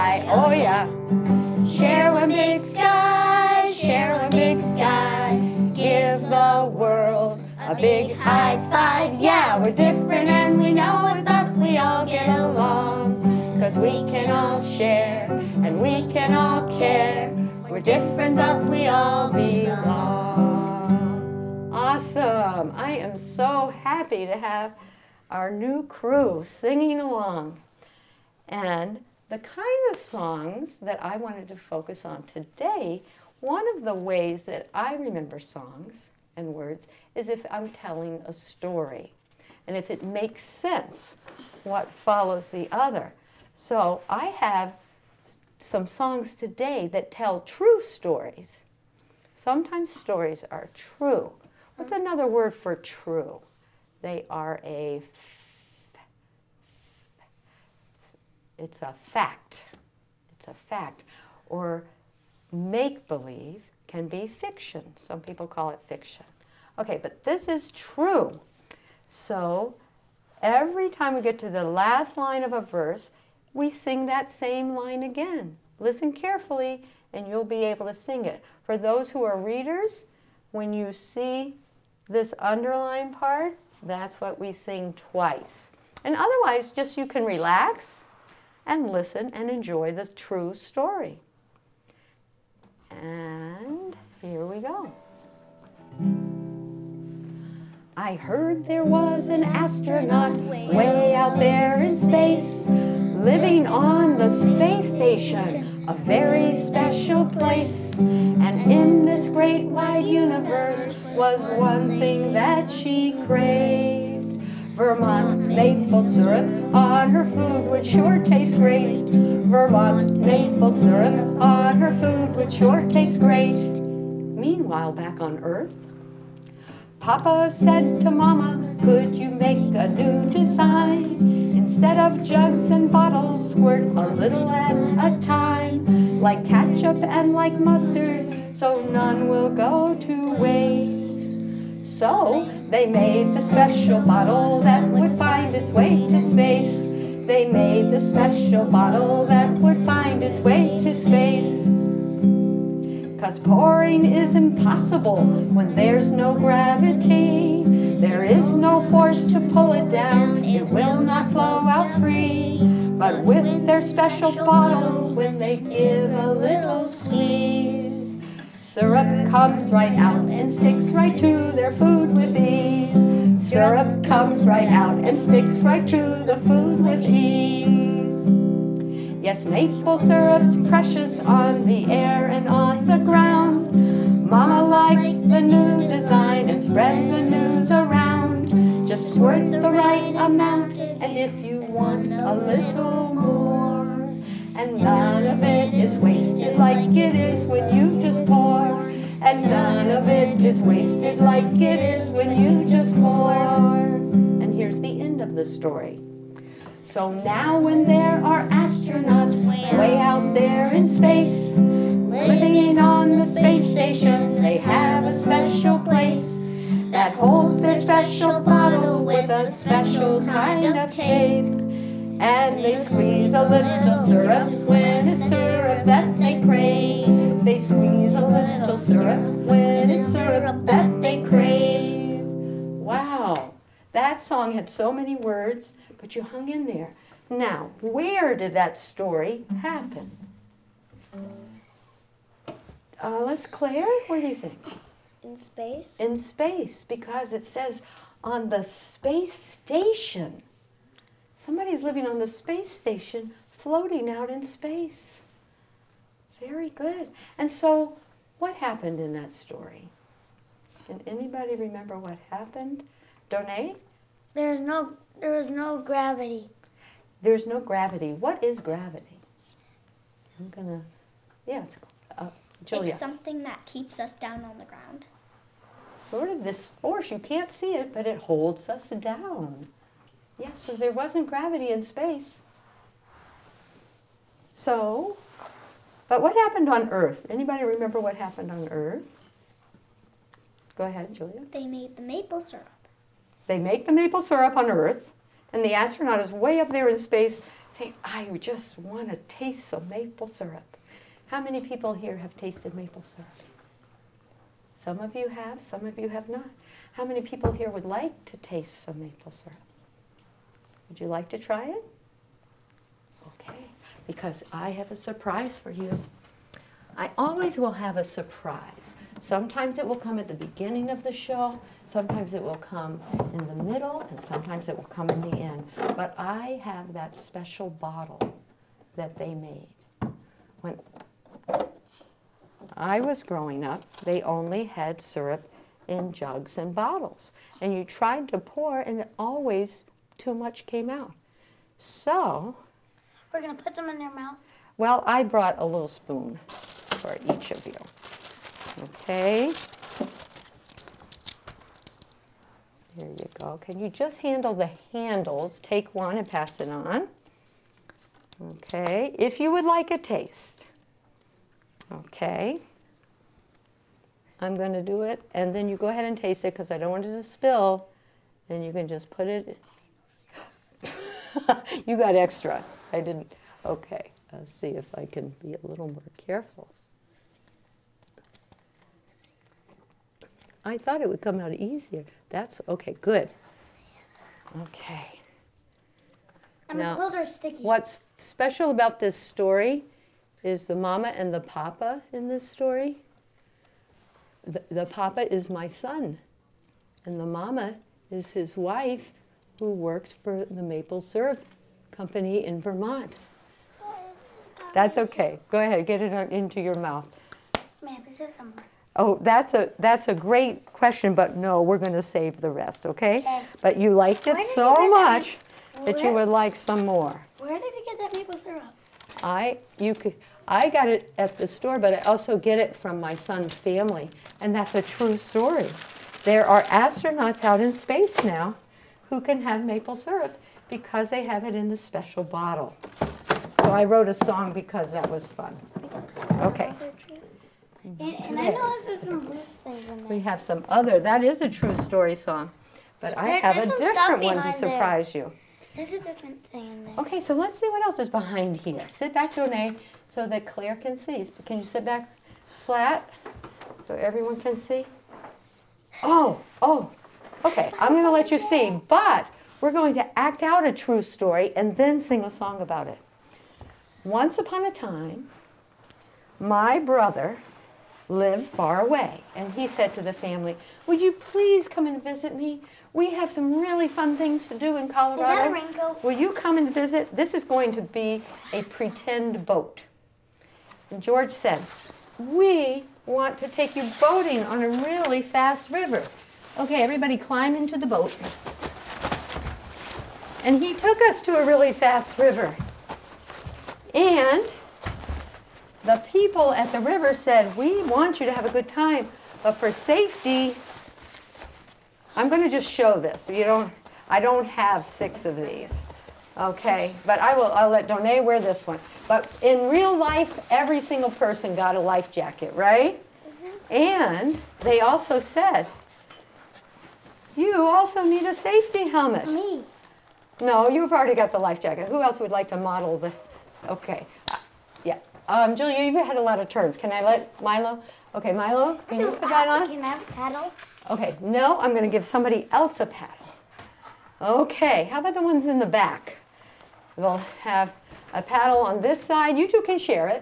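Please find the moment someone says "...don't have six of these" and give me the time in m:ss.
8:24.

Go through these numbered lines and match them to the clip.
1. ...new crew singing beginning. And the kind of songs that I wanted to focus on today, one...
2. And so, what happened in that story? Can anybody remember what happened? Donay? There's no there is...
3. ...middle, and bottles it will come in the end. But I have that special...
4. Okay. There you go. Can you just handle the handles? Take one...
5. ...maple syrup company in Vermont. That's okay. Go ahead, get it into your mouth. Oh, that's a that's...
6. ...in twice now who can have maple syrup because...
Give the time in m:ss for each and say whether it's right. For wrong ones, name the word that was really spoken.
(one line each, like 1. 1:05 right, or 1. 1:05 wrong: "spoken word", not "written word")
1. 0:25 wrong: "along", not "beginning"
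2. 4:17 right
3. 5:23 wrong: "sometimes", not "bottles"
4. 5:48 right
5. 6:40 right
6. 7:07 wrong: "space", not "twice".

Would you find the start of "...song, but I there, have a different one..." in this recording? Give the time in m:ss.
7:22.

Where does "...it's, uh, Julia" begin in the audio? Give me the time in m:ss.
4:31.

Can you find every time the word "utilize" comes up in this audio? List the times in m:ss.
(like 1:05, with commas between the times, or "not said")
not said.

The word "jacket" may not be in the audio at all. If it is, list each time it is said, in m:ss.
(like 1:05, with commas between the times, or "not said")
8:32, 8:41.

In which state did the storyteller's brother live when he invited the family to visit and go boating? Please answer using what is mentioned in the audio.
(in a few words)
Colorado.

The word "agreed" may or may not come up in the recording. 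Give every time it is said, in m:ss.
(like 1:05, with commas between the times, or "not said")
not said.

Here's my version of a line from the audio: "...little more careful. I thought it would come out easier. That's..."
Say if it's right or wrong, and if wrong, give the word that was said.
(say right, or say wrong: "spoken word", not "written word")
right.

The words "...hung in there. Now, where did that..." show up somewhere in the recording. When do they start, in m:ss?
3:56.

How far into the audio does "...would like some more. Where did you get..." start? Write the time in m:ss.
6:56.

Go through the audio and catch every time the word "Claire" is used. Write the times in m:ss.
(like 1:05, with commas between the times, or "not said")
4:03, 7:30.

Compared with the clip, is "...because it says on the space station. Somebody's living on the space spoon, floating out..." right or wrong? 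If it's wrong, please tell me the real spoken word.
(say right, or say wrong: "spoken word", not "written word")
wrong: "station", not "spoon".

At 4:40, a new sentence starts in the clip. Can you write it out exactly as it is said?
Yeah, so there wasn't gravity in space.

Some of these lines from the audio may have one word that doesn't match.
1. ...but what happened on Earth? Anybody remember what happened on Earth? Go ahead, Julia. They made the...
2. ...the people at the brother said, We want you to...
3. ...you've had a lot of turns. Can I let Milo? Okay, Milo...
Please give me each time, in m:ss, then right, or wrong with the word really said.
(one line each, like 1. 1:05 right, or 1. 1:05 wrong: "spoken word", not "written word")
1. 4:46 right
2. 8:15 wrong: "river", not "brother"
3. 8:45 right.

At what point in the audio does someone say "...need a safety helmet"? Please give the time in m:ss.
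8:38.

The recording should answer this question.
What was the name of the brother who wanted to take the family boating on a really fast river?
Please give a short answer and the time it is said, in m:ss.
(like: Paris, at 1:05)
George, at 8:00.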